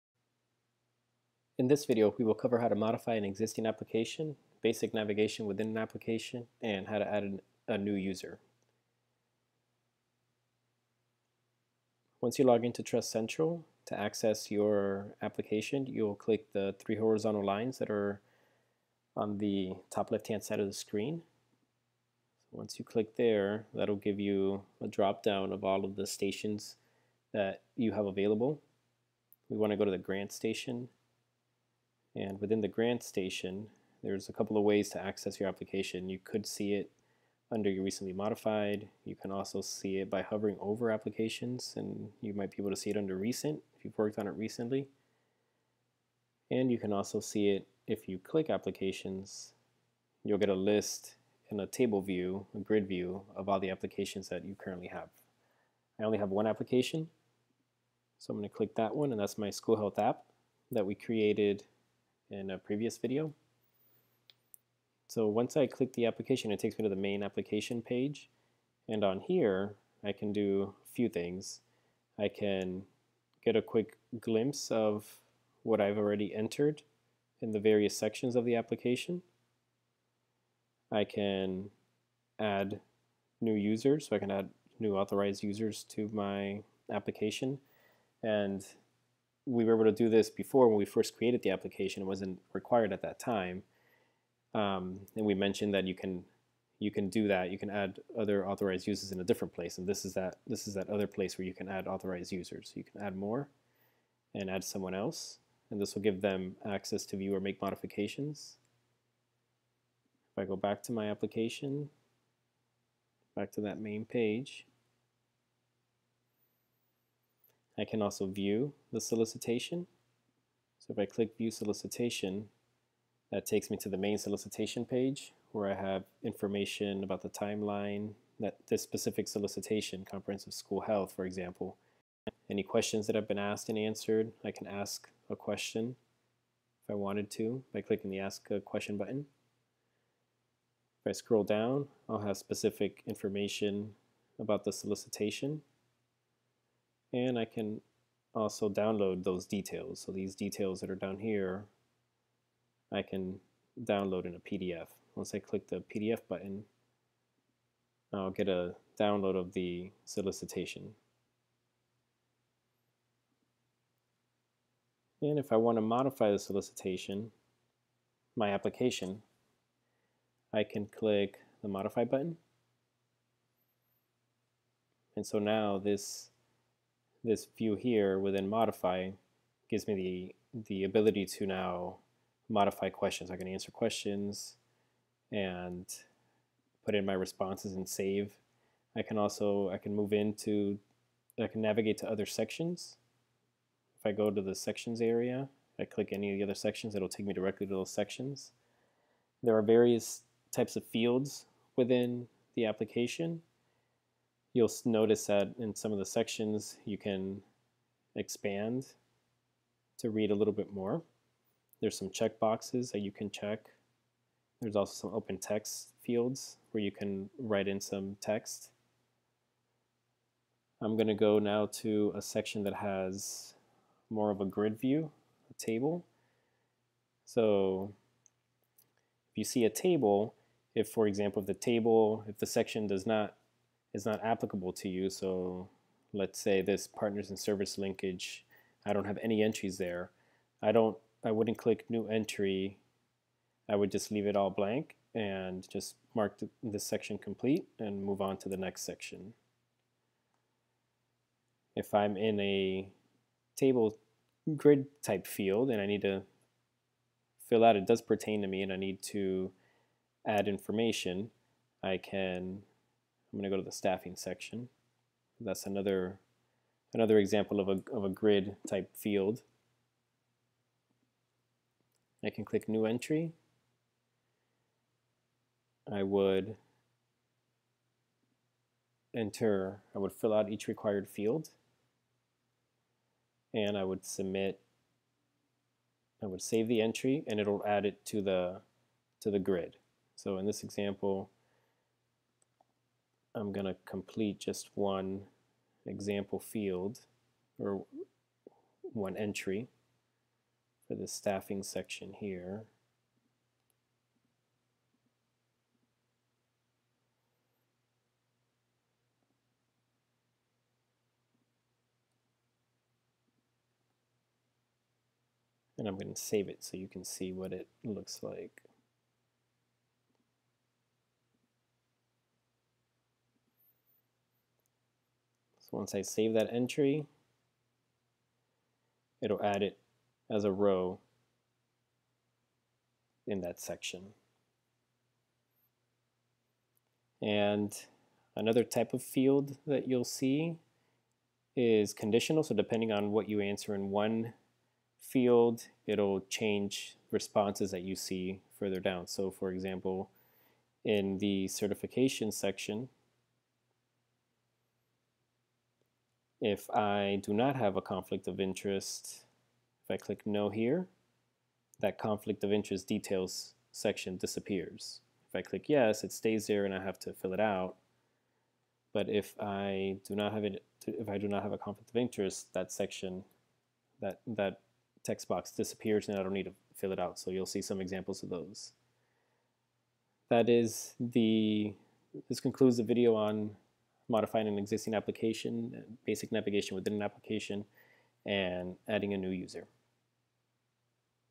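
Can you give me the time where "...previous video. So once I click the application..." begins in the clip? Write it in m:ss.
1:02.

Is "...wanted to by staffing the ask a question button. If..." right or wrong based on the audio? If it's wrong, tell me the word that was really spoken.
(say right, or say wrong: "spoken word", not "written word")
wrong: "clicking", not "staffing".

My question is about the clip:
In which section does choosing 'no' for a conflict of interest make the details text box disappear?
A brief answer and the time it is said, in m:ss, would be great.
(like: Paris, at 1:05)
certification section, at 5:51.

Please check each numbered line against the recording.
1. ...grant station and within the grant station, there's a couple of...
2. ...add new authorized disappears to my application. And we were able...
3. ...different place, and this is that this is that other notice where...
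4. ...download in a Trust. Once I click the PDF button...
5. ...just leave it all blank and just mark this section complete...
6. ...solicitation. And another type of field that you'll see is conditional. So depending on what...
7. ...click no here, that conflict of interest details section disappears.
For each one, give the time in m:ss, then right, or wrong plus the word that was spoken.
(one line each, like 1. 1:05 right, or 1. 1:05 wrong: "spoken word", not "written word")
1. 0:29 right
2. 1:24 wrong: "users", not "disappears"
3. 1:39 wrong: "place", not "notice"
4. 2:33 wrong: "PDF", not "Trust"
5. 4:03 right
6. 5:33 wrong: "section", not "solicitation"
7. 5:59 right.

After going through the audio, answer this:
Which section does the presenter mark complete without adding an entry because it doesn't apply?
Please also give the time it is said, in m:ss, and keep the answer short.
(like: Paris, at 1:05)
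partners and service linkage, at 3:56.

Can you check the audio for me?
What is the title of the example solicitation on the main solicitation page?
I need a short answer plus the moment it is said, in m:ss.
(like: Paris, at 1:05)
comprehensive school health, at 2:10.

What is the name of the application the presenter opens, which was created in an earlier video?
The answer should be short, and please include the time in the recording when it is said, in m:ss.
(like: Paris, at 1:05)
school health app, at 0:59.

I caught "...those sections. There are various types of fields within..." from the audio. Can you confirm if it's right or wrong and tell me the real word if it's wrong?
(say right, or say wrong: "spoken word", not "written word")
right.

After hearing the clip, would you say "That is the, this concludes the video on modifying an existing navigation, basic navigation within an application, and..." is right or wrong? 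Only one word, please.
wrong.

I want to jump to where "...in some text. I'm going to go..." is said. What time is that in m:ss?
3:37.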